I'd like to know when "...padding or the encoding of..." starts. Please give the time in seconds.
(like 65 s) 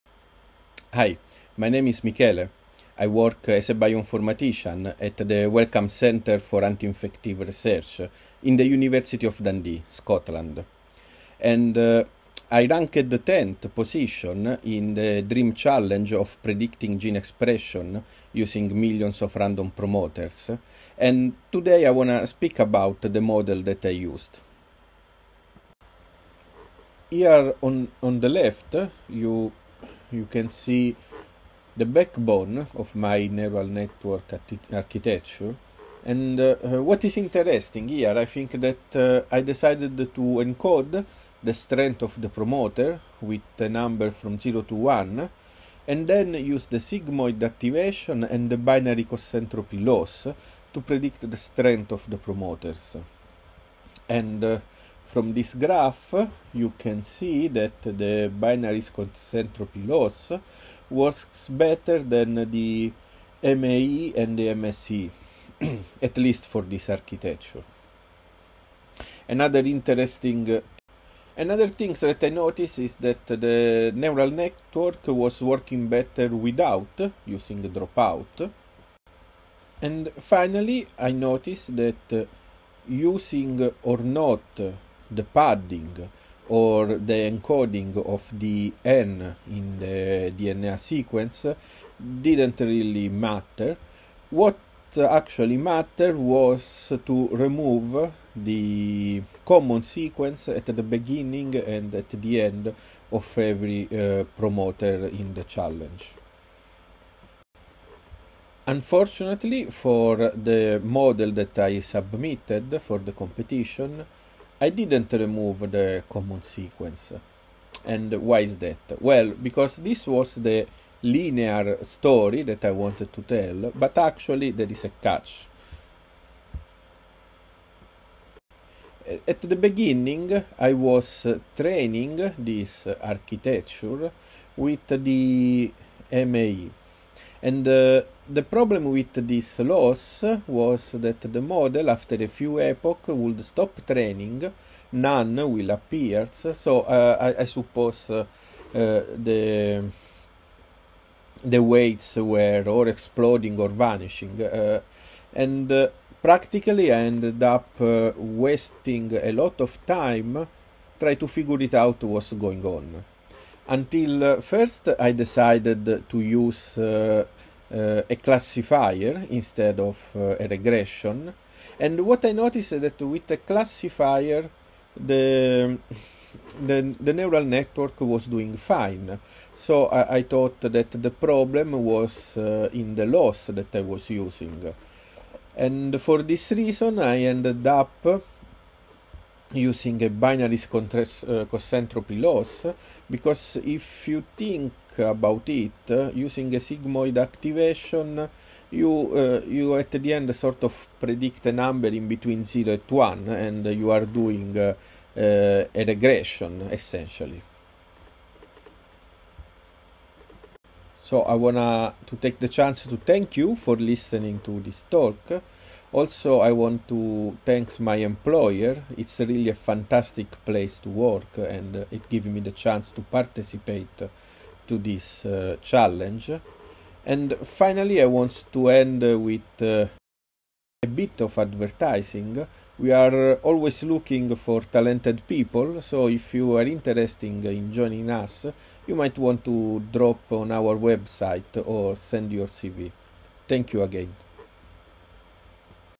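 85 s.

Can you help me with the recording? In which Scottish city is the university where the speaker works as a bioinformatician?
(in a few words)
Dundee.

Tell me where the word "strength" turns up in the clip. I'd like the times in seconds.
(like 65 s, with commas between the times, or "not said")
41 s, 51 s.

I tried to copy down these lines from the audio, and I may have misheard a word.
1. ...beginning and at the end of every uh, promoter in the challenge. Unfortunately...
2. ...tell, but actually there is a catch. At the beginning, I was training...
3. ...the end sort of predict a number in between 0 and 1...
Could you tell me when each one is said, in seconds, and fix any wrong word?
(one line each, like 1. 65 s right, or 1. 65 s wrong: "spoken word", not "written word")
1. 100 s right
2. 123 s right
3. 199 s right.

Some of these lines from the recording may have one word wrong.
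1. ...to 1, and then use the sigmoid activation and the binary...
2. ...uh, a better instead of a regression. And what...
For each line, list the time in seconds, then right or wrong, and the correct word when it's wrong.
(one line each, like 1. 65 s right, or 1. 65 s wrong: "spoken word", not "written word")
1. 44 s right
2. 167 s wrong: "classifier", not "better".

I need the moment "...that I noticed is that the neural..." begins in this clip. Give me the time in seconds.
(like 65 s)
71 s.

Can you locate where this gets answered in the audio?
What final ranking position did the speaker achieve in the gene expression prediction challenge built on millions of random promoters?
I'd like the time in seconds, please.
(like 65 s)
13 s.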